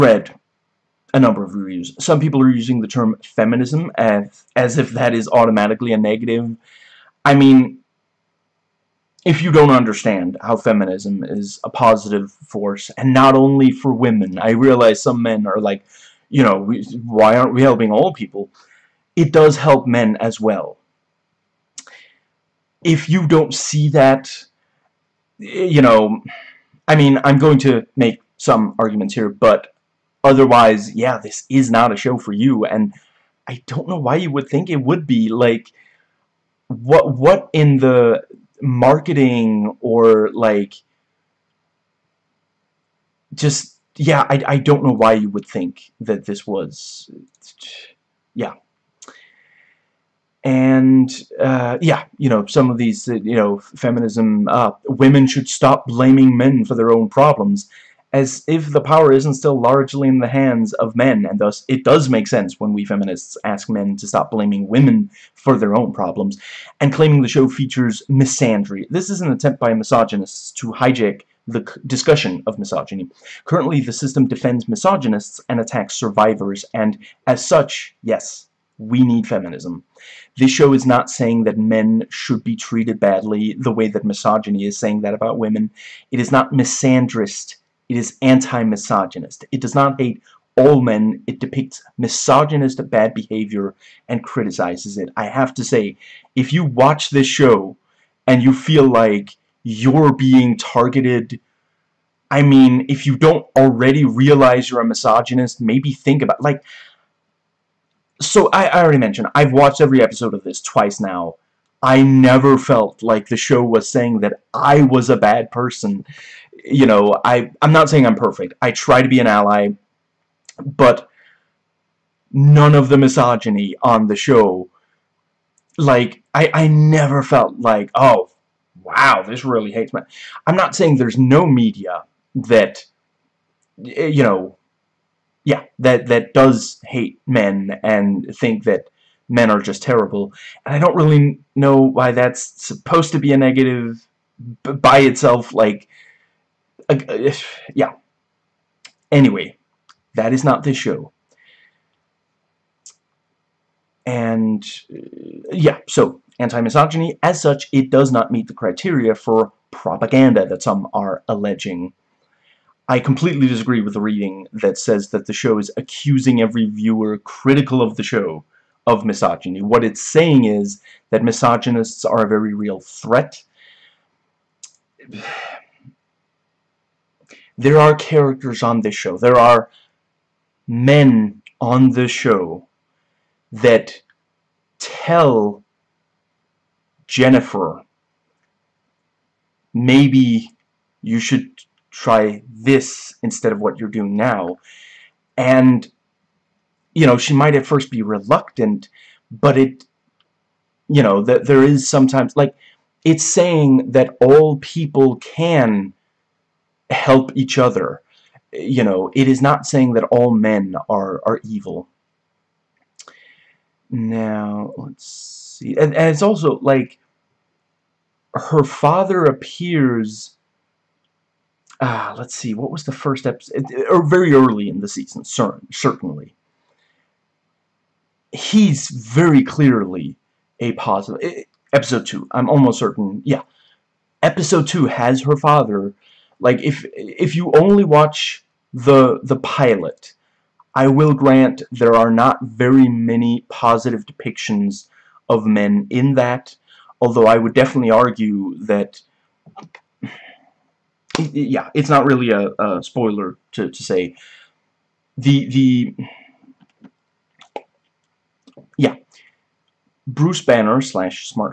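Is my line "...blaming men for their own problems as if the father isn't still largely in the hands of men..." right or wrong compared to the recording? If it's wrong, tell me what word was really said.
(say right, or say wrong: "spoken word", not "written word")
wrong: "power", not "father".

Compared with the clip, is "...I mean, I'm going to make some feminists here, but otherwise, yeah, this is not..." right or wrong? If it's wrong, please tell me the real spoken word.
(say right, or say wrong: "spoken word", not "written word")
wrong: "arguments", not "feminists".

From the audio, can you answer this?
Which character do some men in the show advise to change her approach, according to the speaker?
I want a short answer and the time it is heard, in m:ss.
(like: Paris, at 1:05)
Jennifer, at 3:07.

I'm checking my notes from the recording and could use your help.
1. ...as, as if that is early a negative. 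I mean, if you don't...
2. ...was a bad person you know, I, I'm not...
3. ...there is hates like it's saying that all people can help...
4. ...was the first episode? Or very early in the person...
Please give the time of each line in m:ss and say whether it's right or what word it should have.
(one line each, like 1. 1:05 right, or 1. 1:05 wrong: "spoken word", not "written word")
1. 0:03 wrong: "automatically", not "early"
2. 1:54 right
3. 3:21 wrong: "sometimes", not "hates"
4. 3:42 wrong: "season", not "person".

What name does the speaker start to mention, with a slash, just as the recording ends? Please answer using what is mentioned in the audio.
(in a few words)
Bruce Banner.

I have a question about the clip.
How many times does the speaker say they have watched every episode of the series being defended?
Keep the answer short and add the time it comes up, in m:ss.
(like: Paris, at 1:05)
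twice, at 1:50.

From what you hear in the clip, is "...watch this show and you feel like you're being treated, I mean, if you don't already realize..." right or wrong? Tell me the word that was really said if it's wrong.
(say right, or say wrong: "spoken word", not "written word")
wrong: "targeted", not "treated".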